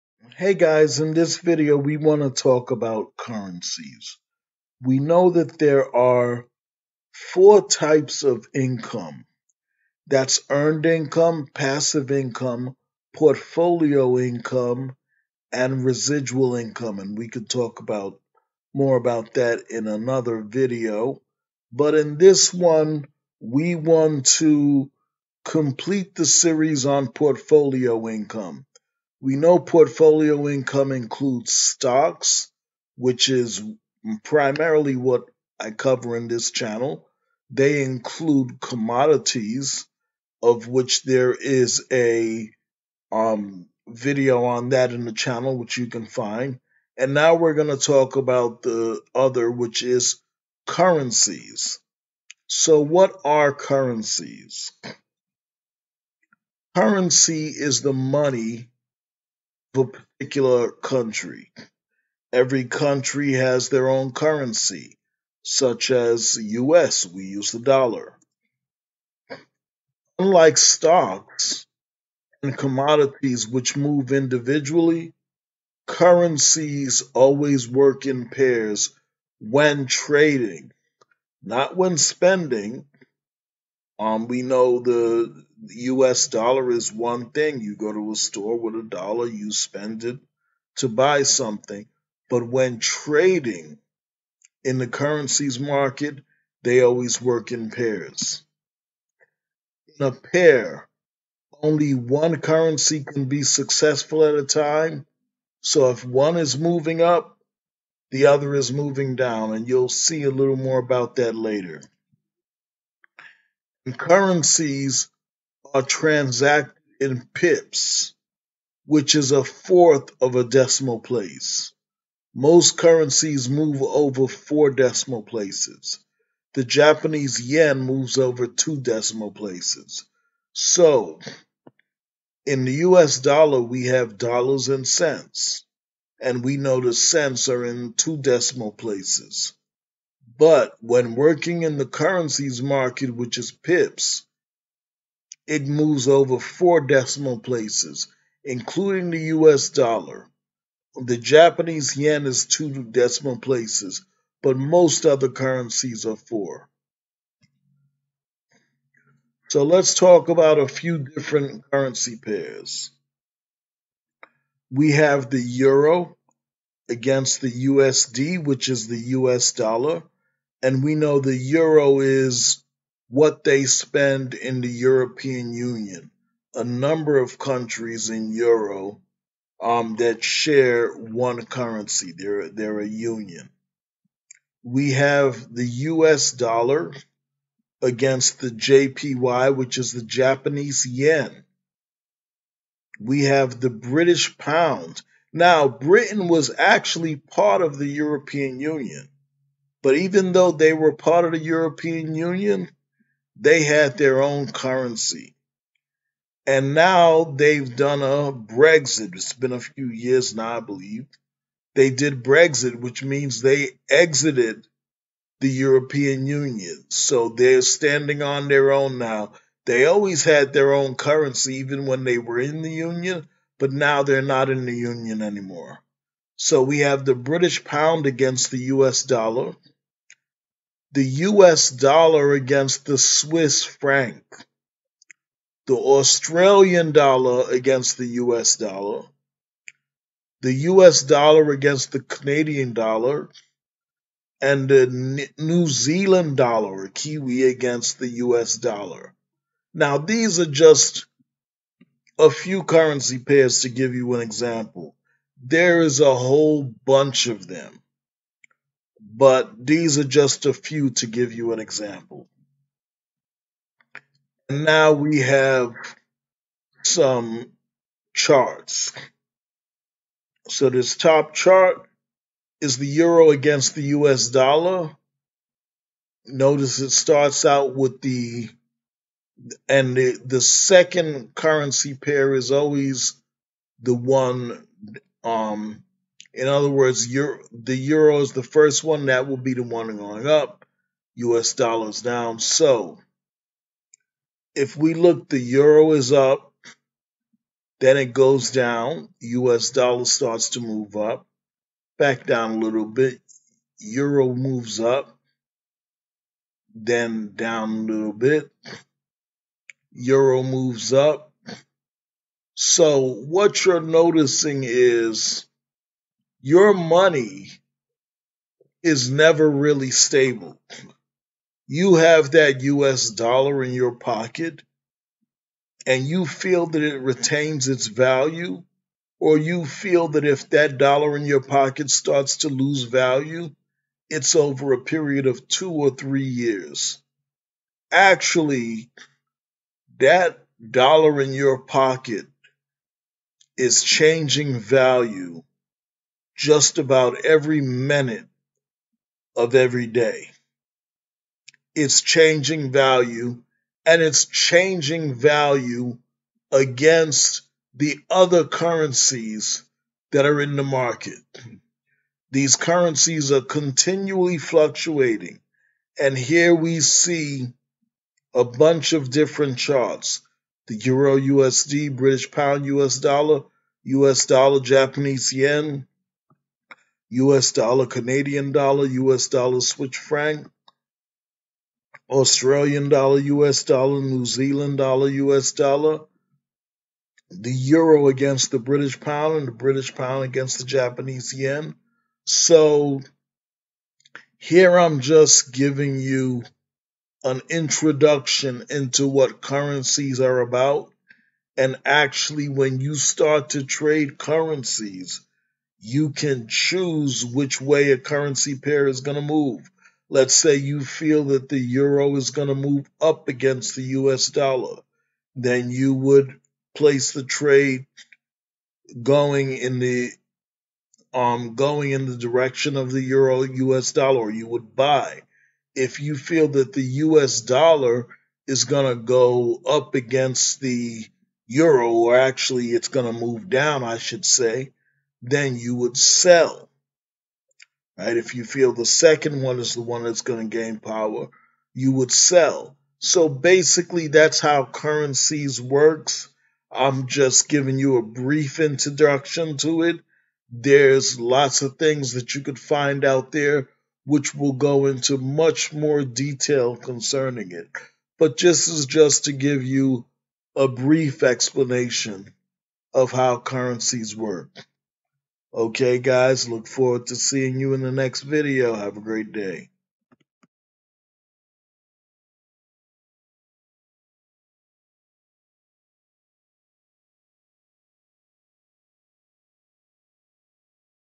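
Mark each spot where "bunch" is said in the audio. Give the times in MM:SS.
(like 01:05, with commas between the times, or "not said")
04:16, 06:08.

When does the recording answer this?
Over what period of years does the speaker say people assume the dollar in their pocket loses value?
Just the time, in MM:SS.
05:35.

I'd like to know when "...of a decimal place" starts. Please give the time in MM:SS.
02:00.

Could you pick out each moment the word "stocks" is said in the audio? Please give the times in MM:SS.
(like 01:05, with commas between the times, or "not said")
00:31, 01:10.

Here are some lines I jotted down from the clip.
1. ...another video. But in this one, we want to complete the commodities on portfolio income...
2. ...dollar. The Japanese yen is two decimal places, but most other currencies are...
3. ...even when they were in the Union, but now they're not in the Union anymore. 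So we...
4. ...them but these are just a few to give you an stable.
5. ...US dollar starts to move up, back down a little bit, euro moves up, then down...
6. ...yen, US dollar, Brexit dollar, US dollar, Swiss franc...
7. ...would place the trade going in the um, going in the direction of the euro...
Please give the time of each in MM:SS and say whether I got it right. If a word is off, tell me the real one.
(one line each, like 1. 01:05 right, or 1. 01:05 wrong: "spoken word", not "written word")
1. 00:19 wrong: "series", not "commodities"
2. 02:29 right
3. 03:41 right
4. 04:17 wrong: "example", not "stable"
5. 04:59 right
6. 06:15 wrong: "Canadian", not "Brexit"
7. 06:55 right.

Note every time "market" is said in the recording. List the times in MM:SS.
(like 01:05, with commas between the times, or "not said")
01:35, 02:22, 06:00.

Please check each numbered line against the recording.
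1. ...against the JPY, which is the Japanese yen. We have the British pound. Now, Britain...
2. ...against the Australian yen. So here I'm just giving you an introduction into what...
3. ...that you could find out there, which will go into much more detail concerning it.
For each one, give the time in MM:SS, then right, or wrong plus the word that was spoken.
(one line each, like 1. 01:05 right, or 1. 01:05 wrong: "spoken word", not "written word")
1. 03:07 right
2. 06:30 wrong: "Japanese", not "Australian"
3. 07:32 right.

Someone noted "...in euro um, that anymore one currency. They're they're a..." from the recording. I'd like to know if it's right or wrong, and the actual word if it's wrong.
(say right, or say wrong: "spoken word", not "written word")
wrong: "share", not "anymore".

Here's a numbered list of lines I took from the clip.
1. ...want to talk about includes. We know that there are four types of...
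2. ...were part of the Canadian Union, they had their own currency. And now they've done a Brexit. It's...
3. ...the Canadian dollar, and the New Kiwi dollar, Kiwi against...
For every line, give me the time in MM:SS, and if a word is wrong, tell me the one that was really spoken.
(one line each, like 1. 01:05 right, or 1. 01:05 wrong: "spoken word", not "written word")
1. 00:01 wrong: "currencies", not "includes"
2. 03:20 wrong: "European", not "Canadian"
3. 04:01 wrong: "Zealand", not "Kiwi".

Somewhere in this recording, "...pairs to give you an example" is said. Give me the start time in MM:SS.
04:13.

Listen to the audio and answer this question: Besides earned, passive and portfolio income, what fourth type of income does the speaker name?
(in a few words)
Residual income.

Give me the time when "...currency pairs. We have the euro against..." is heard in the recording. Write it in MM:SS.
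02:41.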